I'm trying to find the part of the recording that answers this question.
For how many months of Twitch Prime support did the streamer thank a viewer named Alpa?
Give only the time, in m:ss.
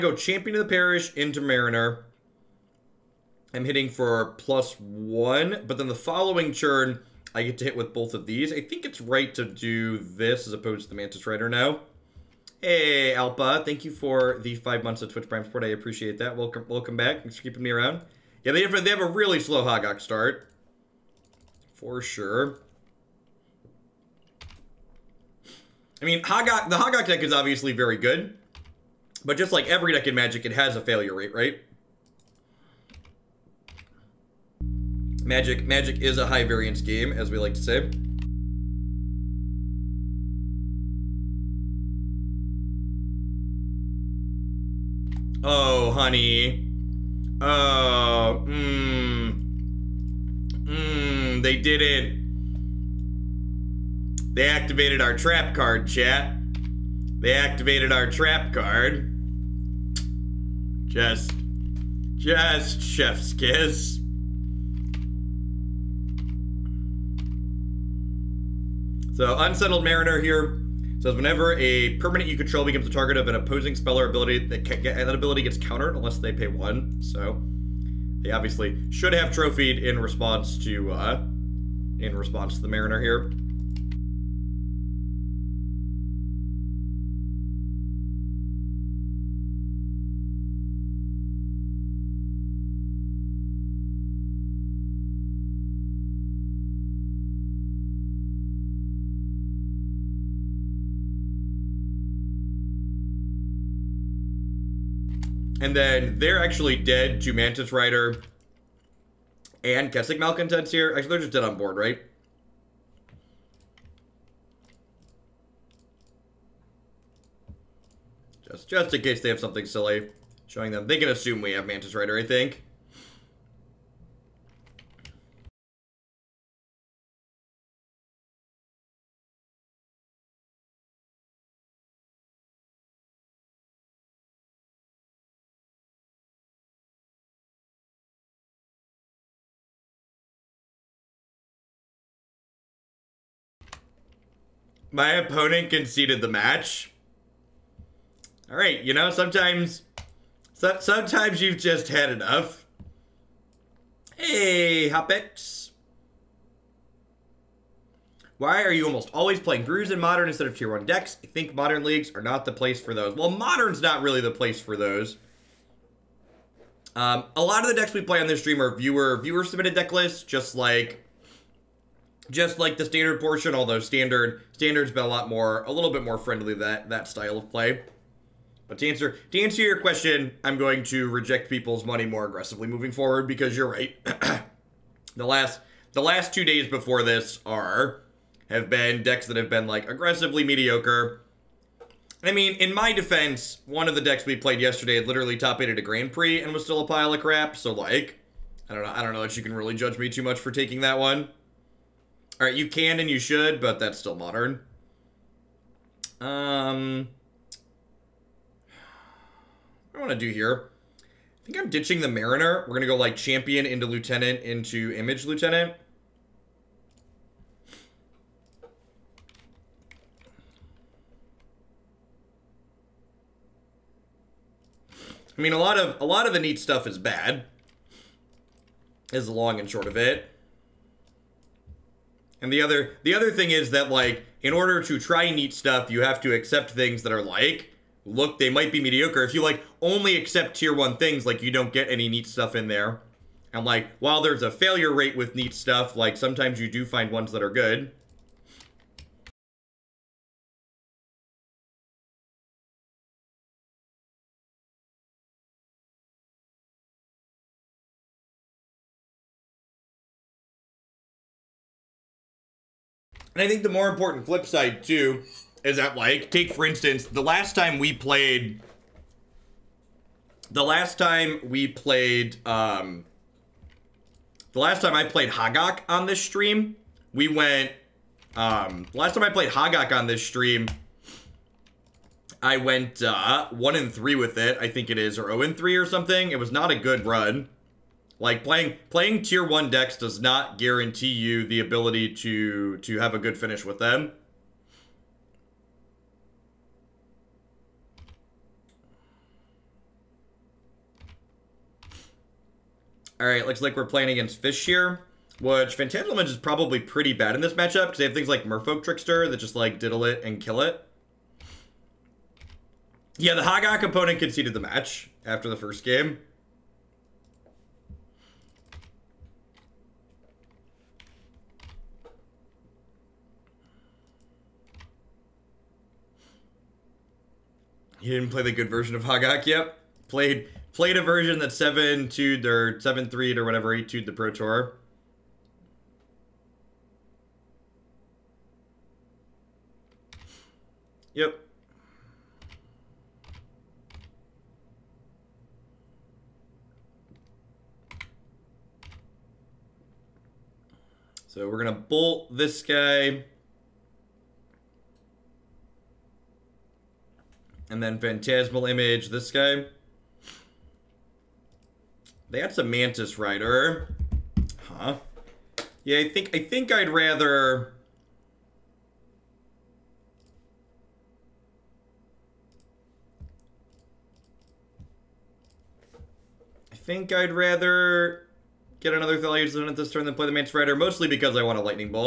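0:14.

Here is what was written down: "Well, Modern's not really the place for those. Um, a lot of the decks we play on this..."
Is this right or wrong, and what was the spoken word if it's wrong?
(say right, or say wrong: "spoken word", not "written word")
right.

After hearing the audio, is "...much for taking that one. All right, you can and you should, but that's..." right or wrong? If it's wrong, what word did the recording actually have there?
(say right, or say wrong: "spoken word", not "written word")
right.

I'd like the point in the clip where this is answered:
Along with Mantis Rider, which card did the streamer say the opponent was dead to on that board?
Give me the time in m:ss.
1:49.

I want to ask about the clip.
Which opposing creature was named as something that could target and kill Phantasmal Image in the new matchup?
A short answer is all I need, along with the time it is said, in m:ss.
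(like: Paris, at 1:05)
Merfolk Trickster, at 5:08.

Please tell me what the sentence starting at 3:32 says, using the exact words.
We're going to go like champion into lieutenant into image lieutenant.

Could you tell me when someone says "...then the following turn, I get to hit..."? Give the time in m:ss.
0:05.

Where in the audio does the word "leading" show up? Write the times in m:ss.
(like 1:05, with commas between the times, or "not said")
not said.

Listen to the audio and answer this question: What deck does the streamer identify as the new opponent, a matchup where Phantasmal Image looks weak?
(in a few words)
Fish.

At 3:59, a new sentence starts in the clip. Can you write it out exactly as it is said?
If you like only accept tier 1 things, like you don't get any neat stuff in there.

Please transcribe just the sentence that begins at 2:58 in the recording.
But to answer to answer your question, I'm going to reject people's money more aggressively moving forward because you're right.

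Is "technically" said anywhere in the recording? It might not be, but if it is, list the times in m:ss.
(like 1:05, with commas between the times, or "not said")
not said.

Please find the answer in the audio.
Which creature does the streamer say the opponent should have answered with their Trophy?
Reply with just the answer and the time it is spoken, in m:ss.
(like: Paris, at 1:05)
Unsettled Mariner, at 1:09.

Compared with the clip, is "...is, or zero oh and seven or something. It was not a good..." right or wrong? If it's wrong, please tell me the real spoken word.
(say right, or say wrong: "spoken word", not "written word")
wrong: "three", not "seven".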